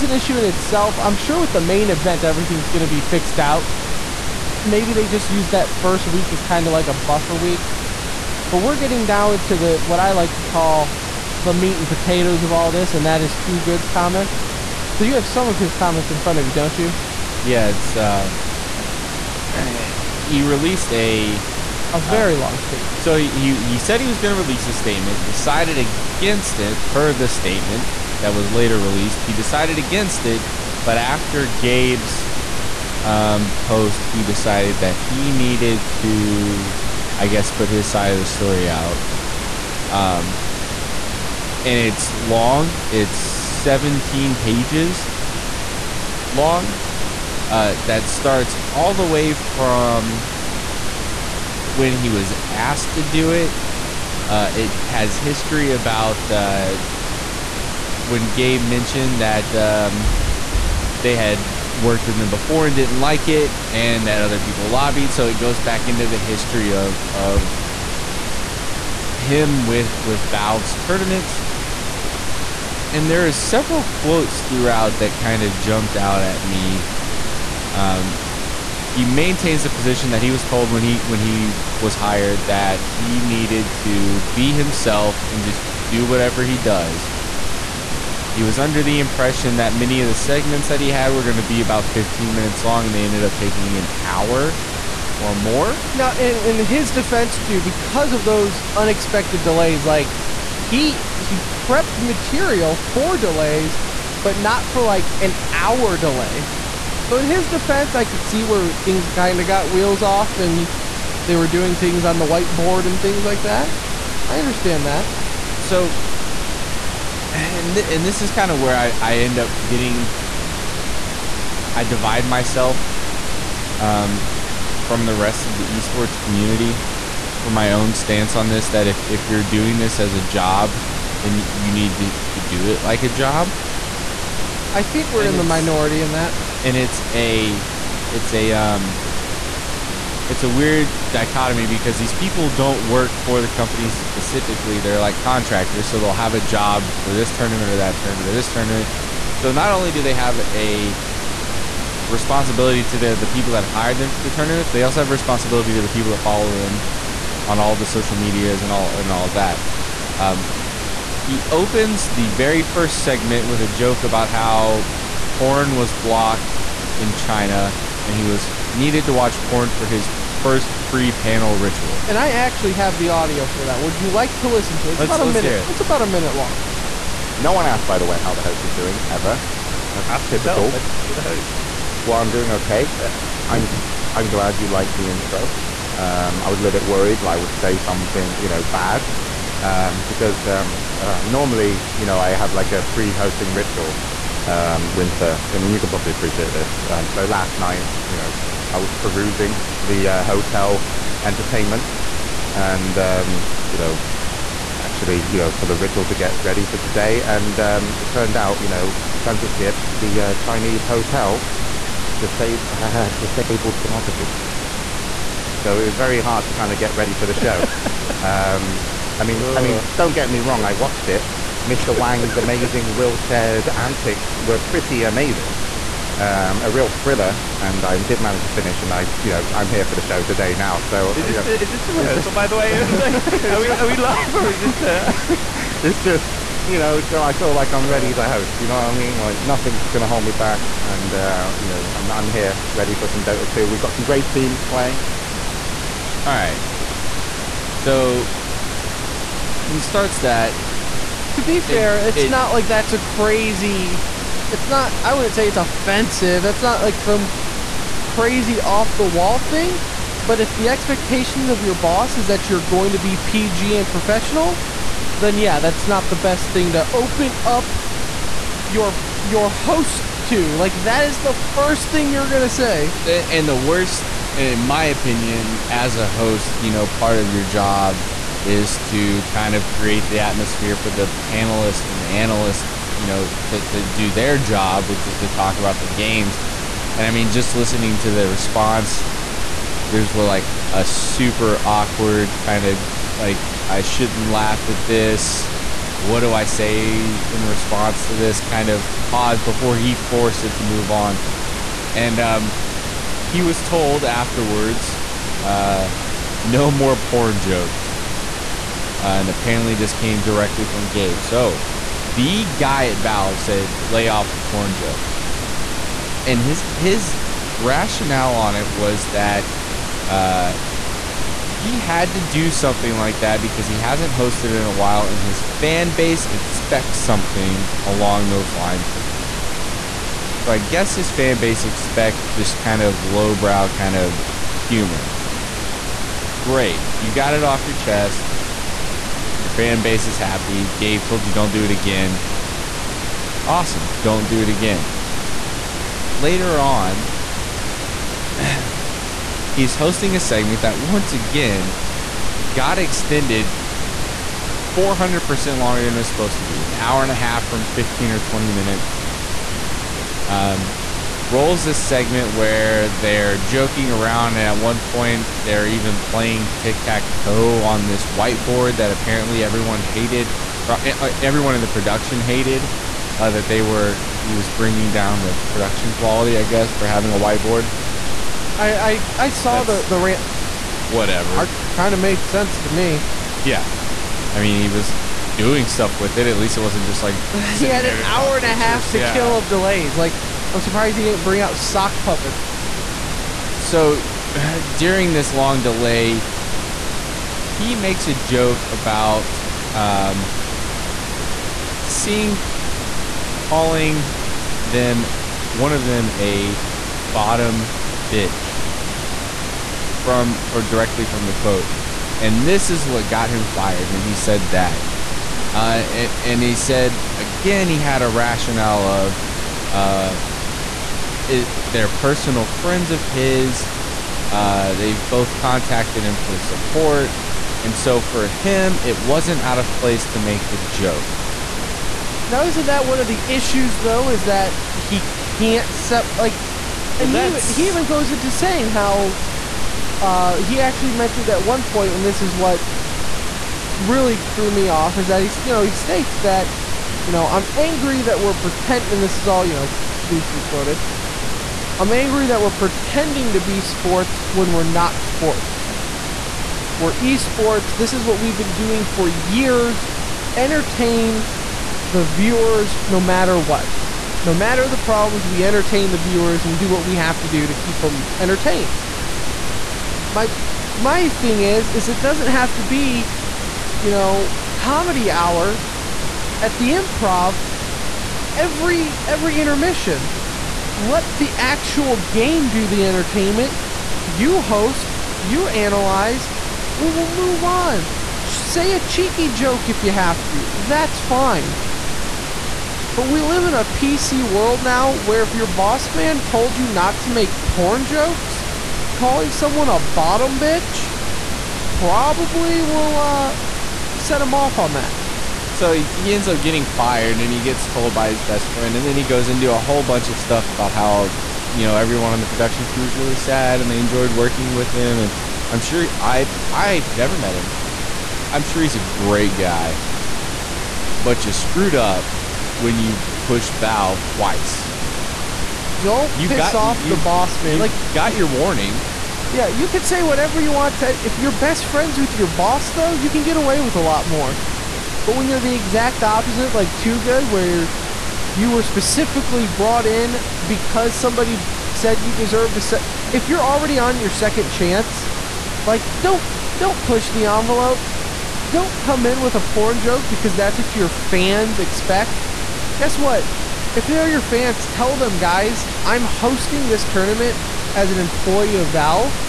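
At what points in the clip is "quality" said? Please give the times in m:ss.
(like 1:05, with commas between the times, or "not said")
6:15.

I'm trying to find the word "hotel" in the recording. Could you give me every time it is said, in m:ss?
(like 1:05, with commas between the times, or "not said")
3:20, 3:30.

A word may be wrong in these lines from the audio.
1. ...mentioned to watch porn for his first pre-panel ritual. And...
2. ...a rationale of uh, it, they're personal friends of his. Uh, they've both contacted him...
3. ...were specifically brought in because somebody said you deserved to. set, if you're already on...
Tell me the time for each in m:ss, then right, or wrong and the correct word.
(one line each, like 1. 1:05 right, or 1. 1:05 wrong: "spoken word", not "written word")
1. 2:48 wrong: "needed", not "mentioned"
2. 6:58 right
3. 8:58 right.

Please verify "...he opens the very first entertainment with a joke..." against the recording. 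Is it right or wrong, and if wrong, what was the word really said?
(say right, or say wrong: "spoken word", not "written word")
wrong: "segment", not "entertainment".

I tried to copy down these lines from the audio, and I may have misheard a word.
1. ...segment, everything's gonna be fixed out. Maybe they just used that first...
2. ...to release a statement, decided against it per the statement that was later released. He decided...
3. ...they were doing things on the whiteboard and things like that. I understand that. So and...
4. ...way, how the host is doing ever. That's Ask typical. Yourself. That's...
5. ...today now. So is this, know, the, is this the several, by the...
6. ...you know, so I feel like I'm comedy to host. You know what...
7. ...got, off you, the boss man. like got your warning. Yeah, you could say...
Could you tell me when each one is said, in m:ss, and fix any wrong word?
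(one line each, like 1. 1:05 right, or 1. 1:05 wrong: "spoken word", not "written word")
1. 0:01 wrong: "event", not "segment"
2. 0:24 right
3. 1:51 right
4. 2:58 right
5. 3:50 wrong: "rehearsal", not "several"
6. 3:56 wrong: "ready", not "comedy"
7. 8:46 right.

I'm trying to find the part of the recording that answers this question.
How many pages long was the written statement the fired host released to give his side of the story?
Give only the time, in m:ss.
0:43.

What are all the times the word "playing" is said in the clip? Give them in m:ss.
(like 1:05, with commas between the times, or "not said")
4:04, 6:06.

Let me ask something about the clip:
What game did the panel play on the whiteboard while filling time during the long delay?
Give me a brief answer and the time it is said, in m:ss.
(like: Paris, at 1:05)
Tic tac toe, at 6:06.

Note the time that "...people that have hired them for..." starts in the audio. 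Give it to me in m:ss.
2:33.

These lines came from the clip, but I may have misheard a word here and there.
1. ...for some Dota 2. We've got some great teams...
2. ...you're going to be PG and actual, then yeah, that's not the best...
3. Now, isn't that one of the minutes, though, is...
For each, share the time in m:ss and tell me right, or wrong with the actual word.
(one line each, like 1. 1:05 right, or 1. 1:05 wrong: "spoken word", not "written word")
1. 4:02 right
2. 4:22 wrong: "professional", not "actual"
3. 7:12 wrong: "issues", not "minutes".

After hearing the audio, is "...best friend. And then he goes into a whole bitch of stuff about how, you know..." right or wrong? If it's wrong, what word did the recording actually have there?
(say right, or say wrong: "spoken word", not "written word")
wrong: "bunch", not "bitch".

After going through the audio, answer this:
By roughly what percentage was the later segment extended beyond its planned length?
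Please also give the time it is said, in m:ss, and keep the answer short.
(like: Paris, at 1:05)
400%, at 5:54.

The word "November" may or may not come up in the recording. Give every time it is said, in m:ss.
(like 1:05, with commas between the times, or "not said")
not said.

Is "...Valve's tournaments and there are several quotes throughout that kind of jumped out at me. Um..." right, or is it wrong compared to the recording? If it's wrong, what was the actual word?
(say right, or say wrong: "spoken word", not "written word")
right.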